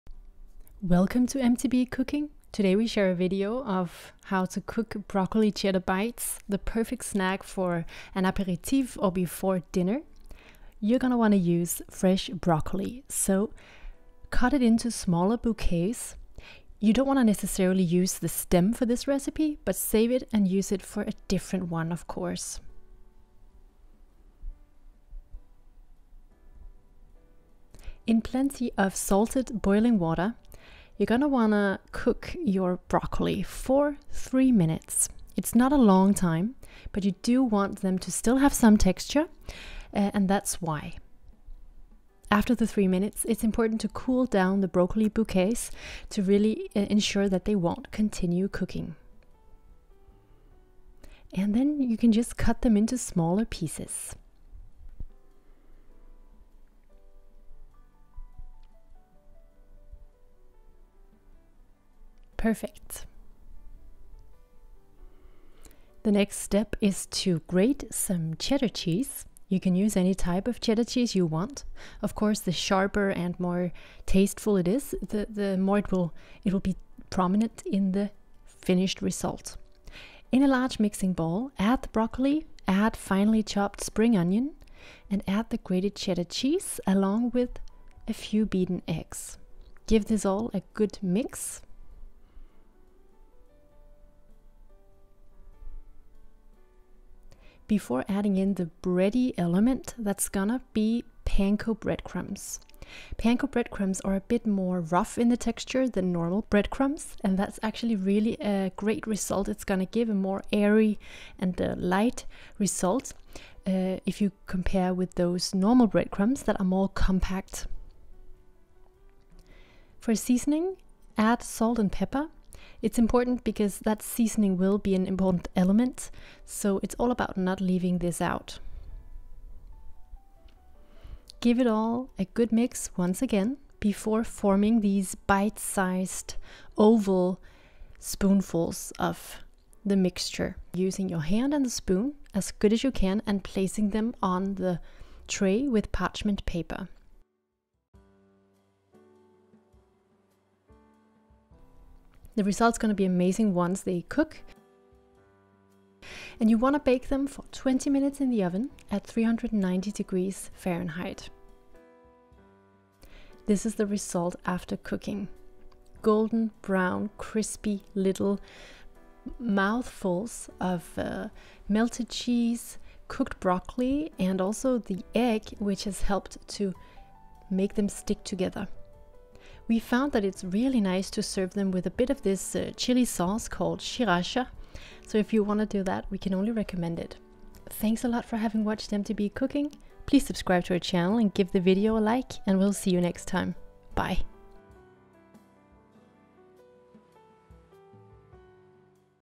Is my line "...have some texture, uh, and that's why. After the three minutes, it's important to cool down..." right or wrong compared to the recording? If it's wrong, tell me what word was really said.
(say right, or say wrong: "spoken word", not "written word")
right.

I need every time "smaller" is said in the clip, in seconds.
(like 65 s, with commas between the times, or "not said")
14 s, 52 s.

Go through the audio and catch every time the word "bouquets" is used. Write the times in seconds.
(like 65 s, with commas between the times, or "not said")
15 s, 45 s.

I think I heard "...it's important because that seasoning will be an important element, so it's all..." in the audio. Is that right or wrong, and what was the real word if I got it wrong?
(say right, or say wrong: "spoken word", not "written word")
right.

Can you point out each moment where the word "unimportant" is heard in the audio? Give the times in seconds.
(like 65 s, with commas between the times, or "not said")
not said.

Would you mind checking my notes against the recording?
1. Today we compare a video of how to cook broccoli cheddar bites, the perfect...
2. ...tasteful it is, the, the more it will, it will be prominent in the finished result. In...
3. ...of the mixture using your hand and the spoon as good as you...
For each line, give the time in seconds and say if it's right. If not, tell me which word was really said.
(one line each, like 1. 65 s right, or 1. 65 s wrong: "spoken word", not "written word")
1. 2 s wrong: "share", not "compare"
2. 74 s right
3. 138 s right.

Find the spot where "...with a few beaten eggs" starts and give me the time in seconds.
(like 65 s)
87 s.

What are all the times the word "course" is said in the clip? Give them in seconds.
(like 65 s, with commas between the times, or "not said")
22 s, 72 s.